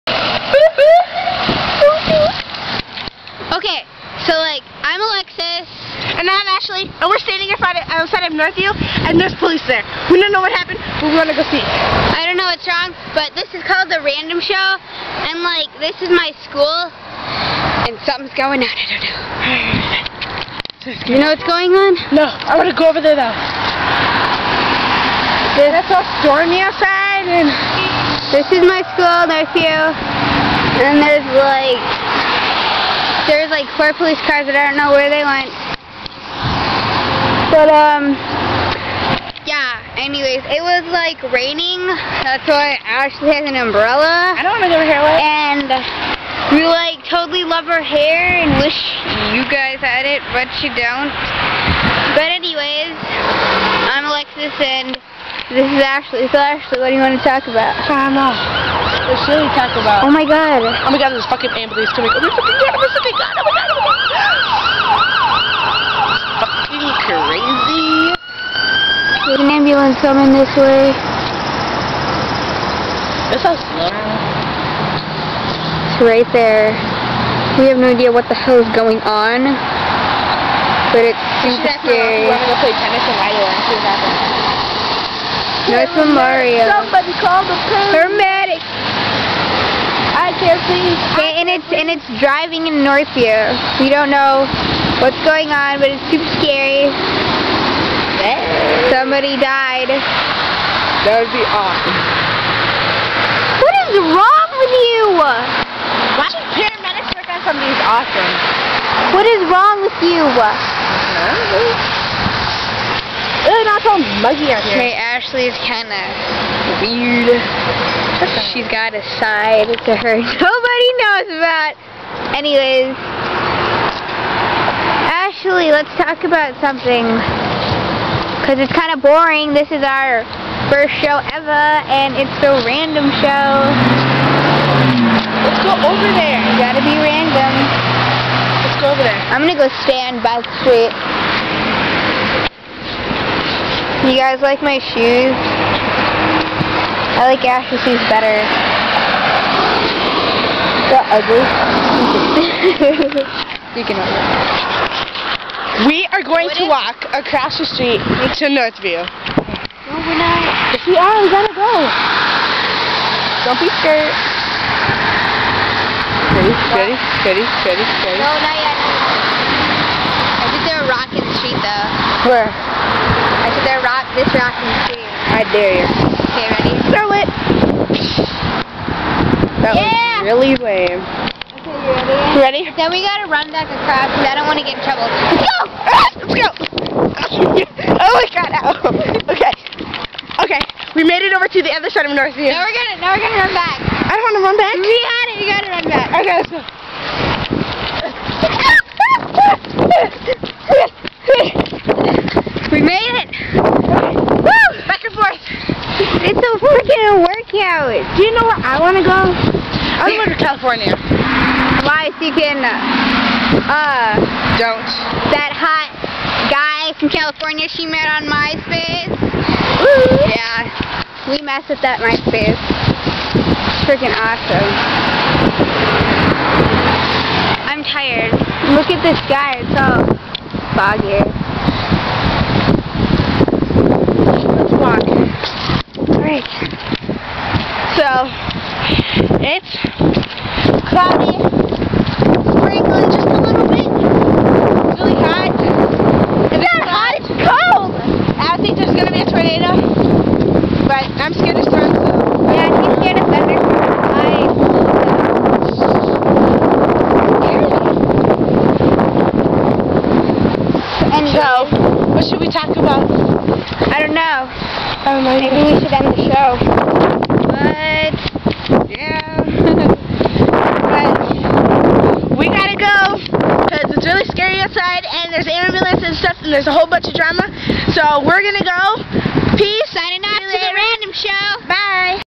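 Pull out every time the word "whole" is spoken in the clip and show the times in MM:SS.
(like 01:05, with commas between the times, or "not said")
04:36.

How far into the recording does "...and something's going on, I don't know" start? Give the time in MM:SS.
00:17.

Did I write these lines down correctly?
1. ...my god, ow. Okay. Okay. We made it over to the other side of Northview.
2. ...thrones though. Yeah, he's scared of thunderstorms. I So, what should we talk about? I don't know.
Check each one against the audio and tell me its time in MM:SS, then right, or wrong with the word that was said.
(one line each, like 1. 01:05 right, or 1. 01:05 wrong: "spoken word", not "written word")
1. 03:08 right
2. 04:11 right.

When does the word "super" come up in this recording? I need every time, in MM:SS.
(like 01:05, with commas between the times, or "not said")
01:21, 01:36.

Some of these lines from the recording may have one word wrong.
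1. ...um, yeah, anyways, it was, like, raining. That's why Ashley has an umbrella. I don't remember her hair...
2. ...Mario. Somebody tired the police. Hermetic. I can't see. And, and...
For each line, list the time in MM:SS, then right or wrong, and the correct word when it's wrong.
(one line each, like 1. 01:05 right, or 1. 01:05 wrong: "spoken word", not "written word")
1. 00:37 right
2. 01:26 wrong: "called", not "tired".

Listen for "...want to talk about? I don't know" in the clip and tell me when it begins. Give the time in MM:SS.
00:57.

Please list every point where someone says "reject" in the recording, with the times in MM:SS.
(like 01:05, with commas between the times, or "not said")
not said.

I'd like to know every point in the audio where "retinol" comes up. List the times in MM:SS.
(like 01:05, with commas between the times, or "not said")
not said.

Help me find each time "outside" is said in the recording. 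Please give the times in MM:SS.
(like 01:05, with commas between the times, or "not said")
00:07, 00:26, 04:34.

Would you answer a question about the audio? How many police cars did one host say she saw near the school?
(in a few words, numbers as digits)
4.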